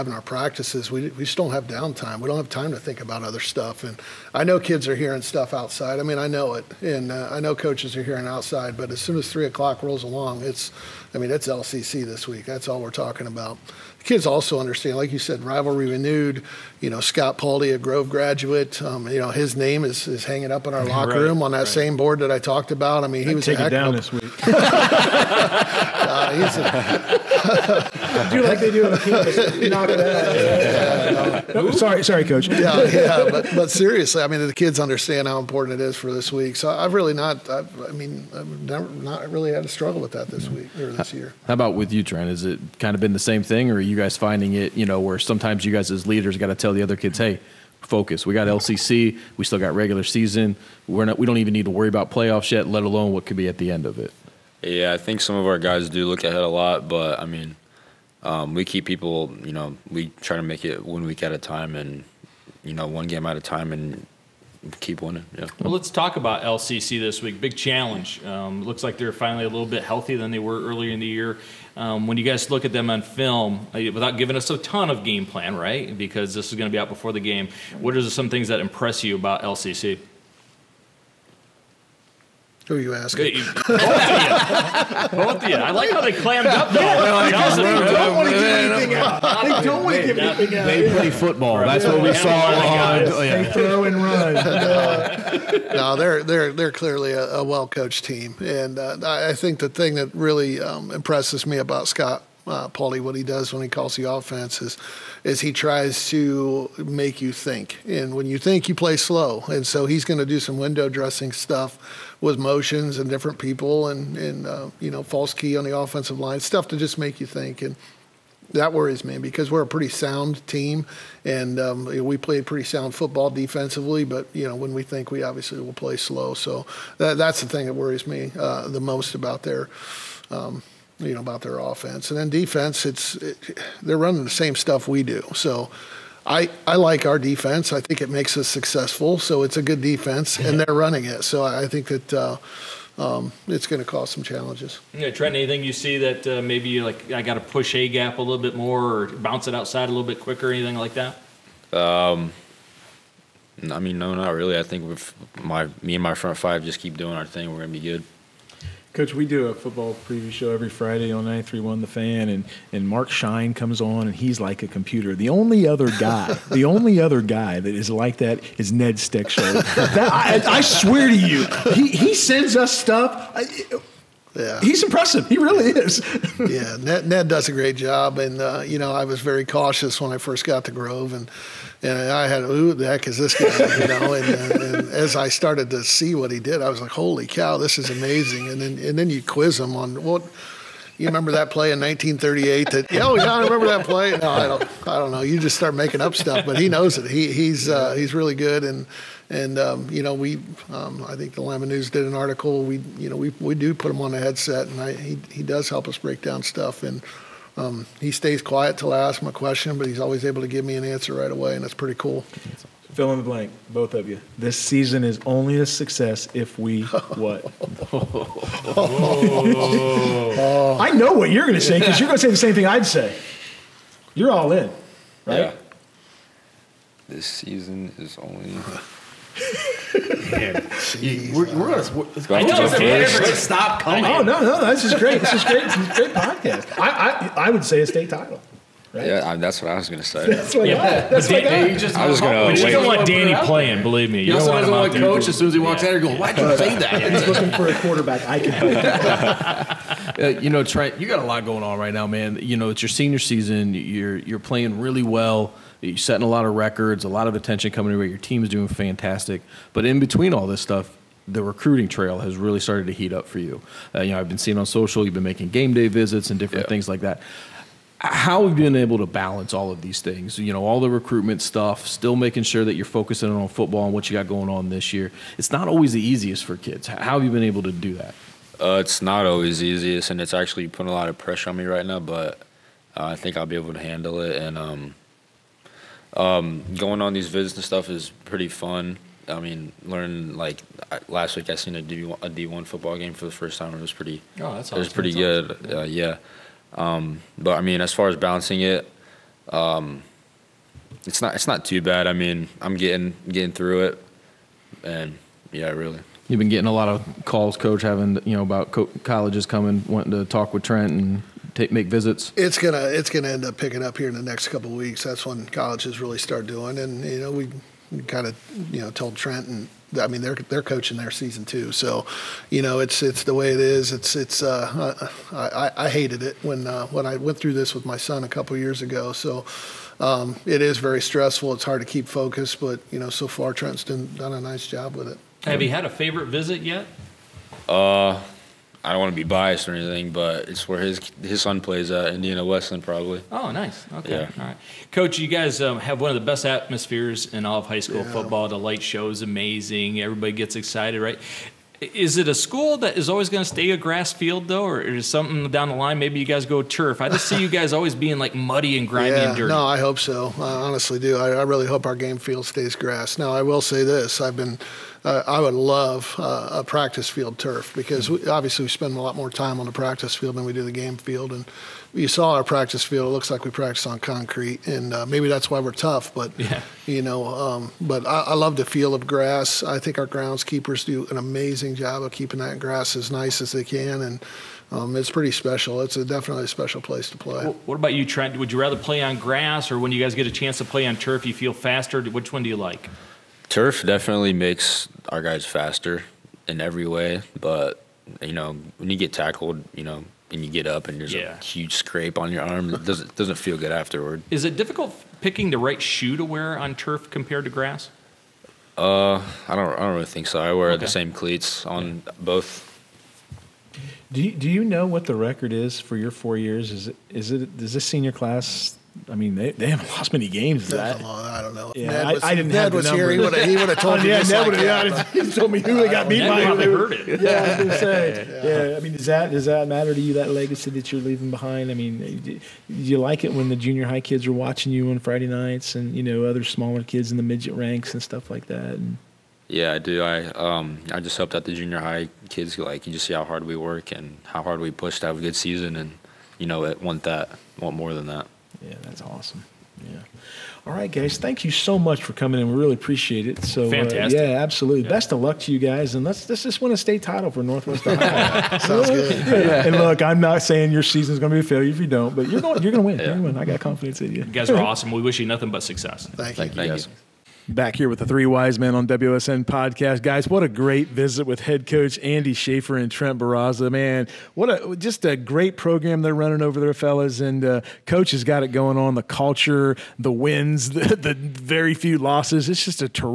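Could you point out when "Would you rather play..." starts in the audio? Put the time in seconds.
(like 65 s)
388 s.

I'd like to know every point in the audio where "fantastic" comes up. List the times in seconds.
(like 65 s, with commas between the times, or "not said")
258 s, 453 s.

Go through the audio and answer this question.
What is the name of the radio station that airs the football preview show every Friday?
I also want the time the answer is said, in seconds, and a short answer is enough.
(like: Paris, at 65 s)
931 The Fan, at 161 s.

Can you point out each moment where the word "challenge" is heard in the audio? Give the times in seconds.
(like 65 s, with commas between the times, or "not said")
67 s, 144 s.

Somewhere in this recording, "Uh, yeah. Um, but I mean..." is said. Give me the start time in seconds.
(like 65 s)
295 s.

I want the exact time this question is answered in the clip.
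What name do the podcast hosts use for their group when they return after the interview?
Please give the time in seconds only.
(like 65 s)
468 s.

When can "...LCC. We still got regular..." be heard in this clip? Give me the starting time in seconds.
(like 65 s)
48 s.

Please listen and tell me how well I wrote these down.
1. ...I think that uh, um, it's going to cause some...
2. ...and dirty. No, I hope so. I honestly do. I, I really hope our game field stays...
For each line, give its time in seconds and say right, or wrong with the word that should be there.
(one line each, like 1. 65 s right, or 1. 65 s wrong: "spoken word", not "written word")
1. 141 s right
2. 359 s right.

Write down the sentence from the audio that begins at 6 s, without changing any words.
I mean, I know it, and uh, I know coaches are hearing outside.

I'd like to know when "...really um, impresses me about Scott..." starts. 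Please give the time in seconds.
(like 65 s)
100 s.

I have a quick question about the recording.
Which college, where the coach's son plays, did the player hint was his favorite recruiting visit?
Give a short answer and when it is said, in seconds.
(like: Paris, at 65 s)
Indiana Wesleyan, at 342 s.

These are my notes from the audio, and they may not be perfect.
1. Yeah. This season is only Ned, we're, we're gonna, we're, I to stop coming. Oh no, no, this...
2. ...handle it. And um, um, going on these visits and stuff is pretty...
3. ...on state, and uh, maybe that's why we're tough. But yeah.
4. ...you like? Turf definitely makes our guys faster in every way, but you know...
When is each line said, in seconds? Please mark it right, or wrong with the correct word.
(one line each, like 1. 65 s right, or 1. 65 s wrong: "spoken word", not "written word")
1. 225 s wrong: "Man", not "Ned"
2. 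283 s right
3. 373 s wrong: "concrete", not "state"
4. 392 s right.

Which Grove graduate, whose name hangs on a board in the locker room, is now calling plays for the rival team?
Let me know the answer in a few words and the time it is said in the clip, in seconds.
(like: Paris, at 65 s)
Scott Pauly, at 17 s.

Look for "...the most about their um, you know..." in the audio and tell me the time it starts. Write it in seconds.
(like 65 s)
128 s.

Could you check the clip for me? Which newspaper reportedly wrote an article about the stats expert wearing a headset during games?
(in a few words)
Lima News.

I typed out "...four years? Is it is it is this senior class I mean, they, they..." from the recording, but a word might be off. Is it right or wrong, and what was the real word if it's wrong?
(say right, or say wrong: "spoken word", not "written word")
right.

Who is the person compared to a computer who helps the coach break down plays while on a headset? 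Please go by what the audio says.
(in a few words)
Ned Stickshell.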